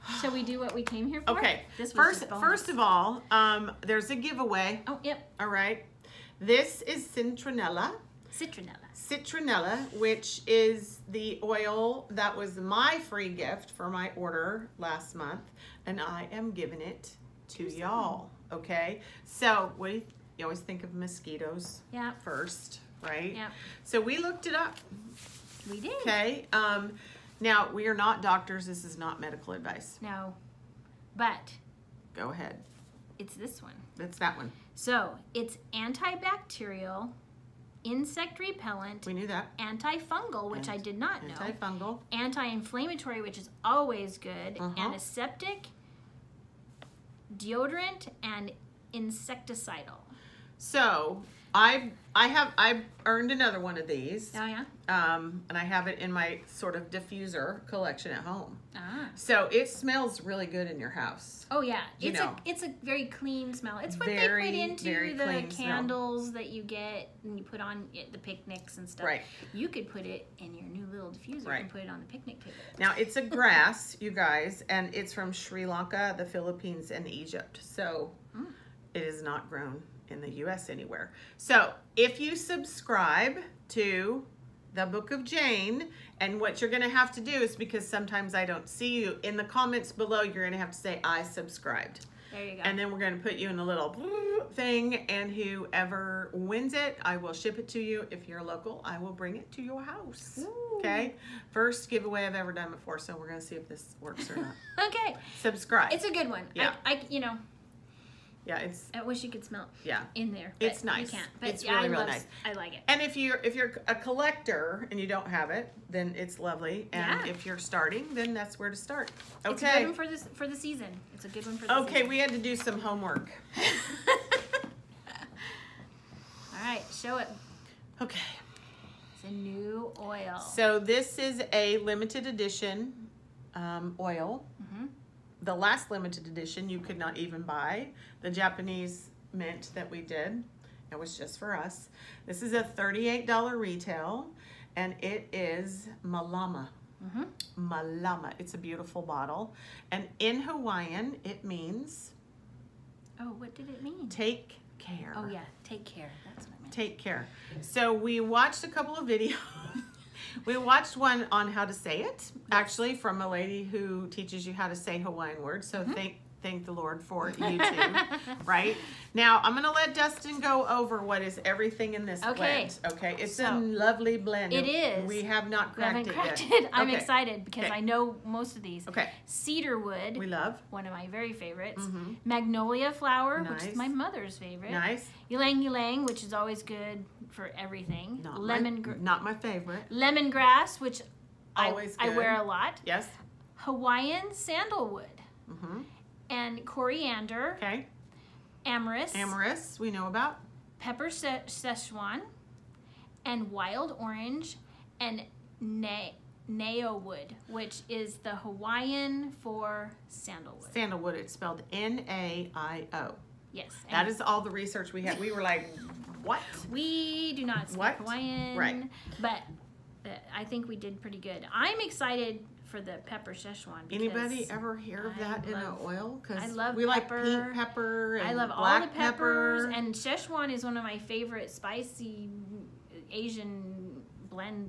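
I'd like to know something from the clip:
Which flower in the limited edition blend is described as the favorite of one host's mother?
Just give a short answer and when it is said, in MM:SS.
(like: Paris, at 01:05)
Magnolia, at 03:02.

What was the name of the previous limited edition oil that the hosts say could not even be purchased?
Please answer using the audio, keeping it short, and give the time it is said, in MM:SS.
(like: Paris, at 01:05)
Japanese mint, at 02:18.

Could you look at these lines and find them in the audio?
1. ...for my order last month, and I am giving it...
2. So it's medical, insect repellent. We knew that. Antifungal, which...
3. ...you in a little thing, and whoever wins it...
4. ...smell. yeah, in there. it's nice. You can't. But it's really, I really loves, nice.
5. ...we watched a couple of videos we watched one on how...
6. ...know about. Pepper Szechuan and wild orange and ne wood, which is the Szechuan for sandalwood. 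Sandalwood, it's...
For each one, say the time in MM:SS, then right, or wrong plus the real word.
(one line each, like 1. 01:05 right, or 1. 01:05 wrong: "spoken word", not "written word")
1. 00:13 right
2. 00:34 wrong: "antibacterial", not "medical"
3. 01:33 right
4. 01:49 right
5. 02:38 right
6. 03:19 wrong: "Hawaiian", not "Szechuan".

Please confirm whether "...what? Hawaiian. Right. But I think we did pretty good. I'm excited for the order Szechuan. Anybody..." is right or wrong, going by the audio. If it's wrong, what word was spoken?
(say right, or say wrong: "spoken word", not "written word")
wrong: "pepper", not "order".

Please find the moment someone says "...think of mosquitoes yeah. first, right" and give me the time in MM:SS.
00:20.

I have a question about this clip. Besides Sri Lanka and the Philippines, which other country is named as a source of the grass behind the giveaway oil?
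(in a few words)
Egypt.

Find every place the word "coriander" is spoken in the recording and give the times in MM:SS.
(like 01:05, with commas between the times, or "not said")
03:16.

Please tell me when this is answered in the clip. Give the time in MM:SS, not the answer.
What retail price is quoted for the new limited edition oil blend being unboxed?
02:22.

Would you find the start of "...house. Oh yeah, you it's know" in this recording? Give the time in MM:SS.
01:00.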